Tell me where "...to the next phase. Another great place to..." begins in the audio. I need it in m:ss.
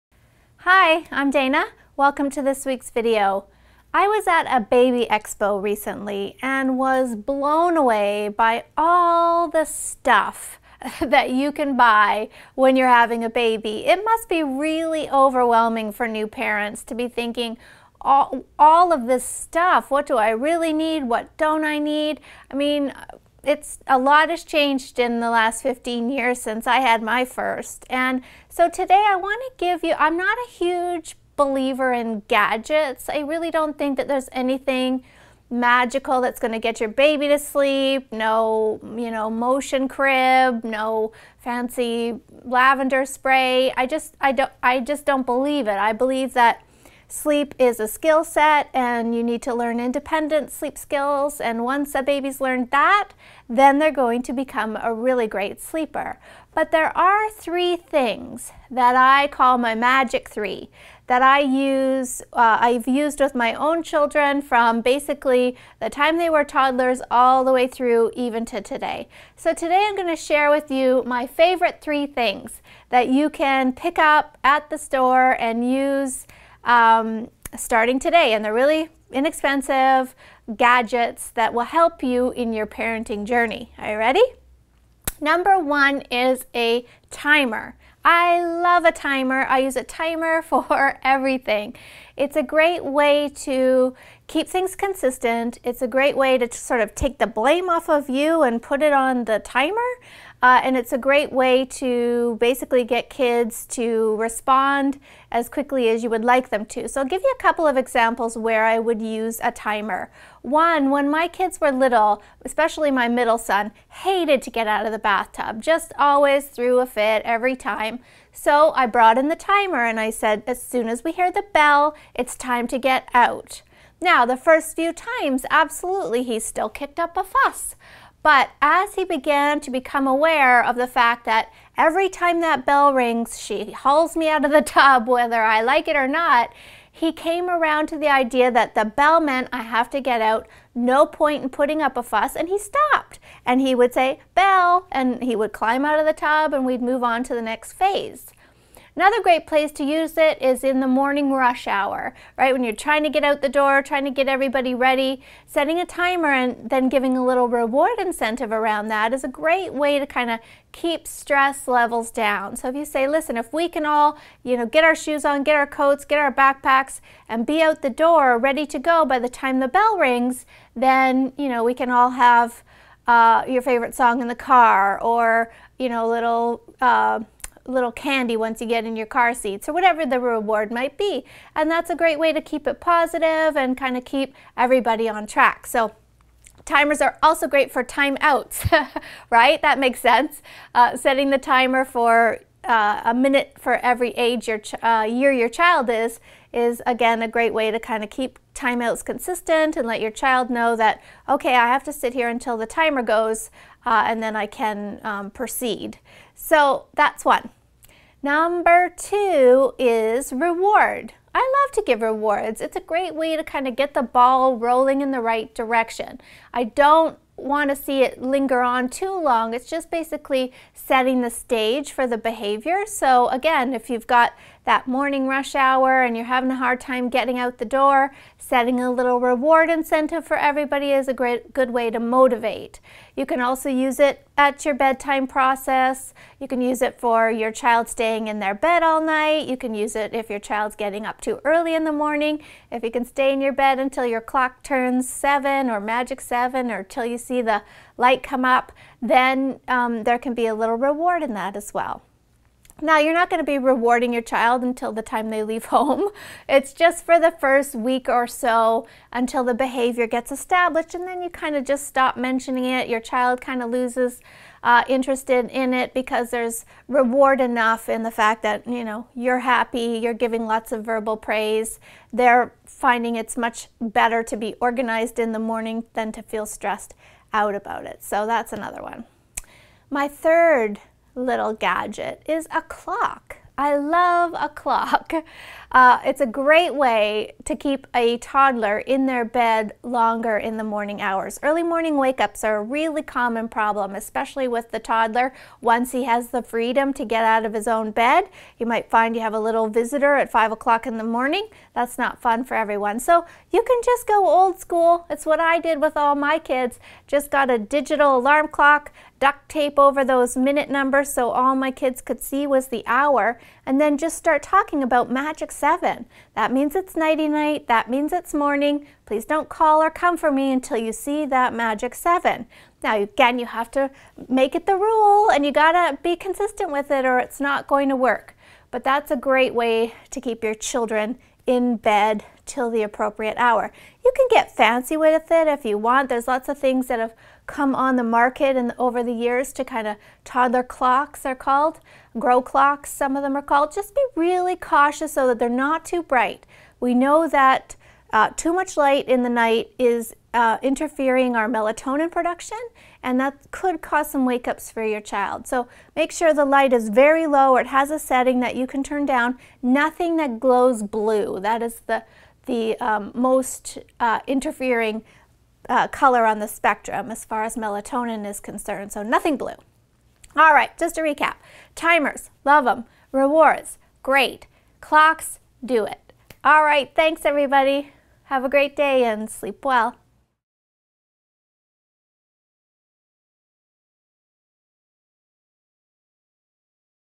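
2:27.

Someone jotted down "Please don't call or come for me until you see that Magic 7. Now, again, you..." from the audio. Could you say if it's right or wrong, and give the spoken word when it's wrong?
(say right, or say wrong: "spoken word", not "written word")
right.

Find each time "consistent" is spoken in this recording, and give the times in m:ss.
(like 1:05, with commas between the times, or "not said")
1:34, 3:19, 5:26.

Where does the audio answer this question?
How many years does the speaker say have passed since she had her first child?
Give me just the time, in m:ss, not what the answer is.
0:25.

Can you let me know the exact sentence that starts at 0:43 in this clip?
I just I don't I just don't believe it.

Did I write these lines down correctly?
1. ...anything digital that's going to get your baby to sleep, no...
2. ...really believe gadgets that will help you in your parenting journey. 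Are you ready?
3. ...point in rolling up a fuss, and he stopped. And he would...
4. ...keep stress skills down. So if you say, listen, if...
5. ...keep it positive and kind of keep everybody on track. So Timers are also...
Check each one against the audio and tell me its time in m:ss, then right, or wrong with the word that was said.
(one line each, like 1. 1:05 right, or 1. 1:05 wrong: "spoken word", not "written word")
1. 0:34 wrong: "magical", not "digital"
2. 1:18 wrong: "inexpensive", not "believe"
3. 2:21 wrong: "putting", not "rolling"
4. 2:40 wrong: "levels", not "skills"
5. 3:02 right.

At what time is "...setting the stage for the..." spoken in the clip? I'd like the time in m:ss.
3:40.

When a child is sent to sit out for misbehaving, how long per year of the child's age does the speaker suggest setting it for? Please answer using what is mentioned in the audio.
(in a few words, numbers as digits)
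A minute.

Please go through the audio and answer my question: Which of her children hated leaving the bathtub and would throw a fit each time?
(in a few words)
Middle son.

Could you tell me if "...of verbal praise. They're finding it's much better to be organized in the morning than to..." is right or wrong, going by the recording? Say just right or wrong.
right.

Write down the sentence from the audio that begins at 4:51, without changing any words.
Early morning wake ups are a really common problem, especially with the toddler.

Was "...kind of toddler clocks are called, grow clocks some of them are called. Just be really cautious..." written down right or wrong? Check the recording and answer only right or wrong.
right.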